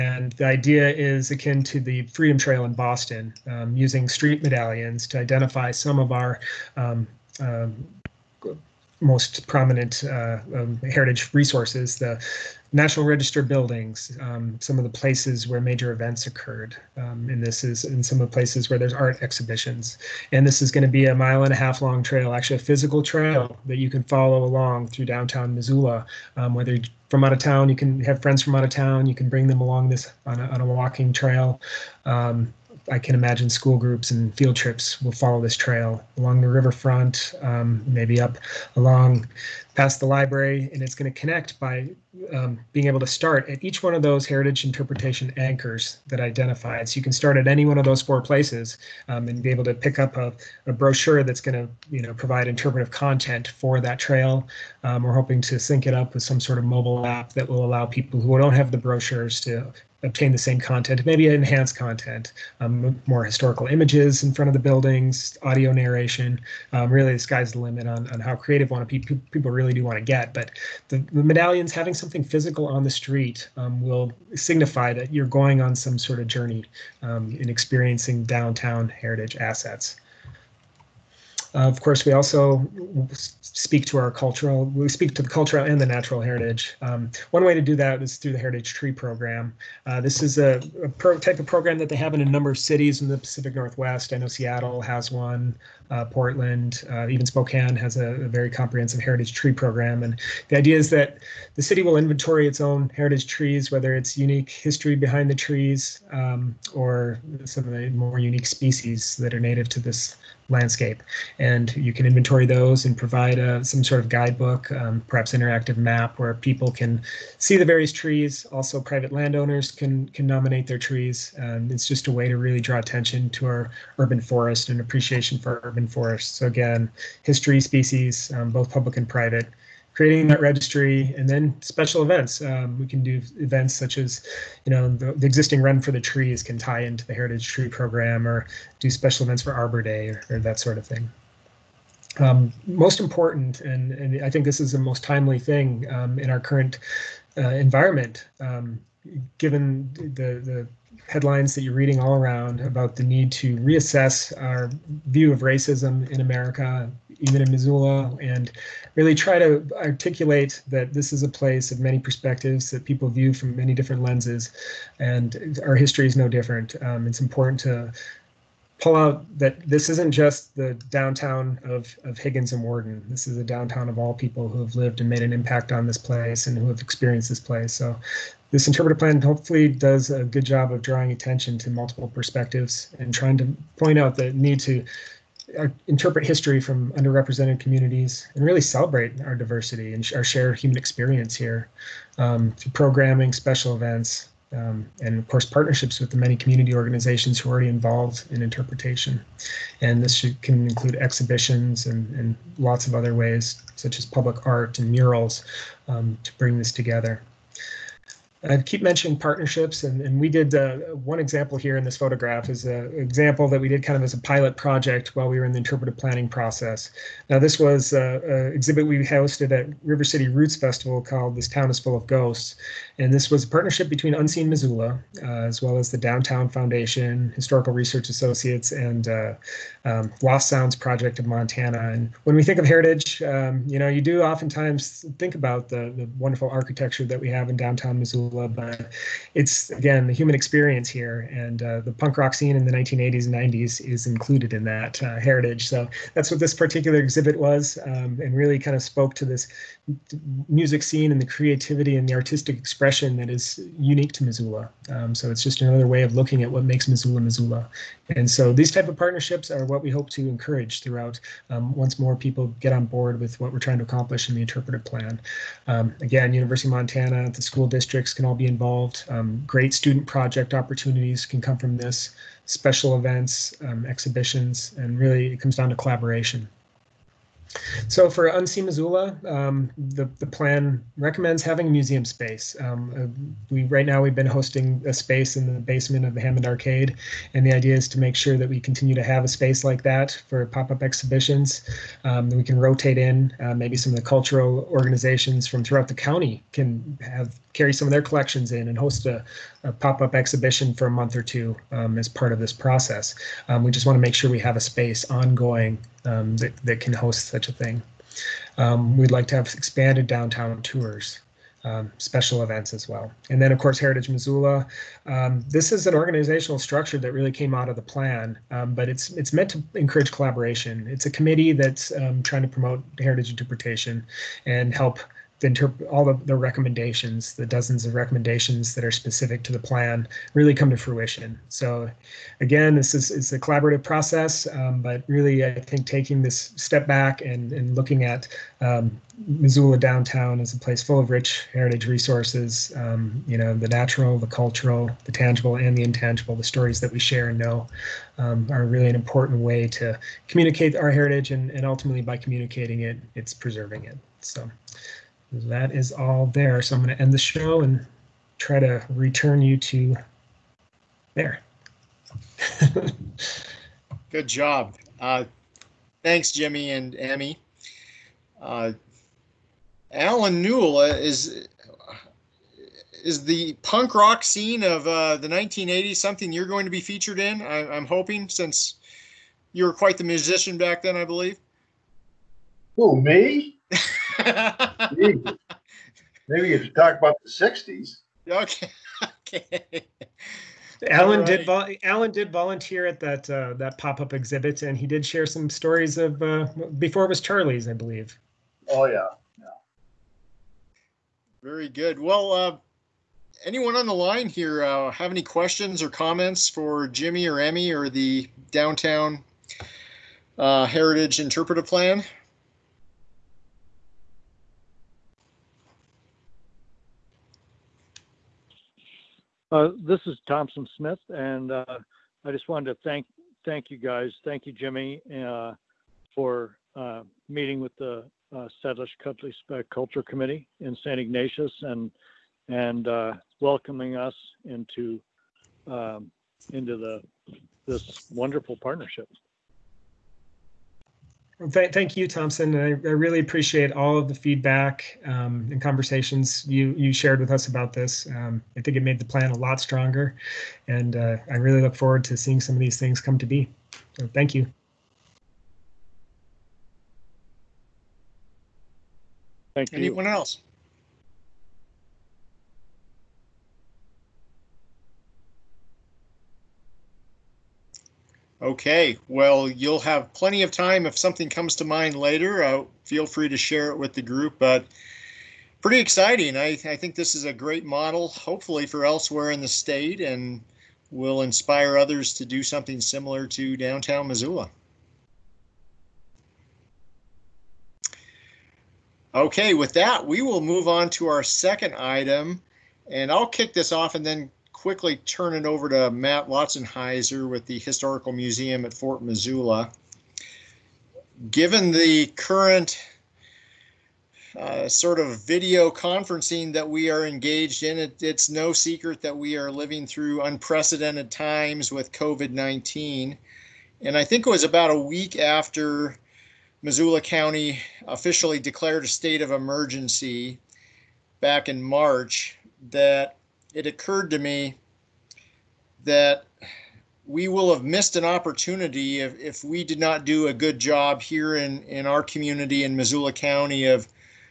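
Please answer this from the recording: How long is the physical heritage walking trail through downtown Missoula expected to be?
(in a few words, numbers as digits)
a mile and a half.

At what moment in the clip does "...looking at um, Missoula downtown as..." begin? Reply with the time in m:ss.
5:37.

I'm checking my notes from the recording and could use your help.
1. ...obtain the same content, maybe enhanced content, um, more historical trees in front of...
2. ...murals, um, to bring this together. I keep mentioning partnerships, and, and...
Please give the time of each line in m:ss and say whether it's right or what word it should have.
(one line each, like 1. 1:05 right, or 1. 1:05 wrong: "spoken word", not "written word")
1. 1:00 wrong: "images", not "trees"
2. 3:24 right.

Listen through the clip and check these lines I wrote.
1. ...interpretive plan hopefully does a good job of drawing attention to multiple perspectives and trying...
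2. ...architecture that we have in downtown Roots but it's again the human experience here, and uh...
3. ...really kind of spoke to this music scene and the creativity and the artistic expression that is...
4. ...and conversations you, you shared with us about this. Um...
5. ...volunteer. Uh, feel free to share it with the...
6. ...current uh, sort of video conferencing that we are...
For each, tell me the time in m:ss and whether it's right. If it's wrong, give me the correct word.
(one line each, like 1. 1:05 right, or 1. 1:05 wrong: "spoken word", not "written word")
1. 2:58 right
2. 3:56 wrong: "Missoula", not "Roots"
3. 4:08 right
4. 7:25 right
5. 7:51 wrong: "later", not "volunteer"
6. 8:22 right.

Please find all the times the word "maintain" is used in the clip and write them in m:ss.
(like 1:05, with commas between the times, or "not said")
not said.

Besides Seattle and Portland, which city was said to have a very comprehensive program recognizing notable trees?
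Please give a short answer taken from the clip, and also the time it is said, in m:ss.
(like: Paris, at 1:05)
Spokane, at 1:37.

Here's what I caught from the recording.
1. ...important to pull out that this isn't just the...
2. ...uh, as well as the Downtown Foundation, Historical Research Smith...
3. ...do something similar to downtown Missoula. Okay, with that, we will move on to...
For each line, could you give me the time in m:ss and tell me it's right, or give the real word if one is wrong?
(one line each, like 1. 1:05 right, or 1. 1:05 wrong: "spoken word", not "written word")
1. 2:47 right
2. 3:45 wrong: "Associates", not "Smith"
3. 8:02 right.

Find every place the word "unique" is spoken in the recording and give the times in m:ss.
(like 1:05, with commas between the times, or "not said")
1:44, 1:48, 4:13.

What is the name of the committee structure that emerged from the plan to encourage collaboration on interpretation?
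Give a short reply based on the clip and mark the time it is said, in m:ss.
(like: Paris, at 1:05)
Heritage Missoula, at 5:13.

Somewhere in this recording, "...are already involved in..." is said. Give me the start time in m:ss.
3:17.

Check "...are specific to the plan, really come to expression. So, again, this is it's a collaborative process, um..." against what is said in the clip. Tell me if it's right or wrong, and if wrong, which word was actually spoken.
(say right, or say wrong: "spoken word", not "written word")
wrong: "fruition", not "expression".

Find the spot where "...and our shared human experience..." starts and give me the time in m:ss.
3:09.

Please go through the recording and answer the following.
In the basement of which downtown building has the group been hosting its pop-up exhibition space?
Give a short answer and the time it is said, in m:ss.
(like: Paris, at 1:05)
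Hammond Arcade, at 4:46.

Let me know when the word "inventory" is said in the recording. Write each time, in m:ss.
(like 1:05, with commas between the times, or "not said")
1:41, 1:52.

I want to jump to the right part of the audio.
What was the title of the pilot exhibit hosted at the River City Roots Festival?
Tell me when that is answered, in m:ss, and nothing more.
3:41.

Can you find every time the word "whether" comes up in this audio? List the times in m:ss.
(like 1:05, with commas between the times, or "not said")
0:26, 1:43.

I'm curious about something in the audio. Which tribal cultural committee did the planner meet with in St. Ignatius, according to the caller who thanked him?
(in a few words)
Salish Culture Committee.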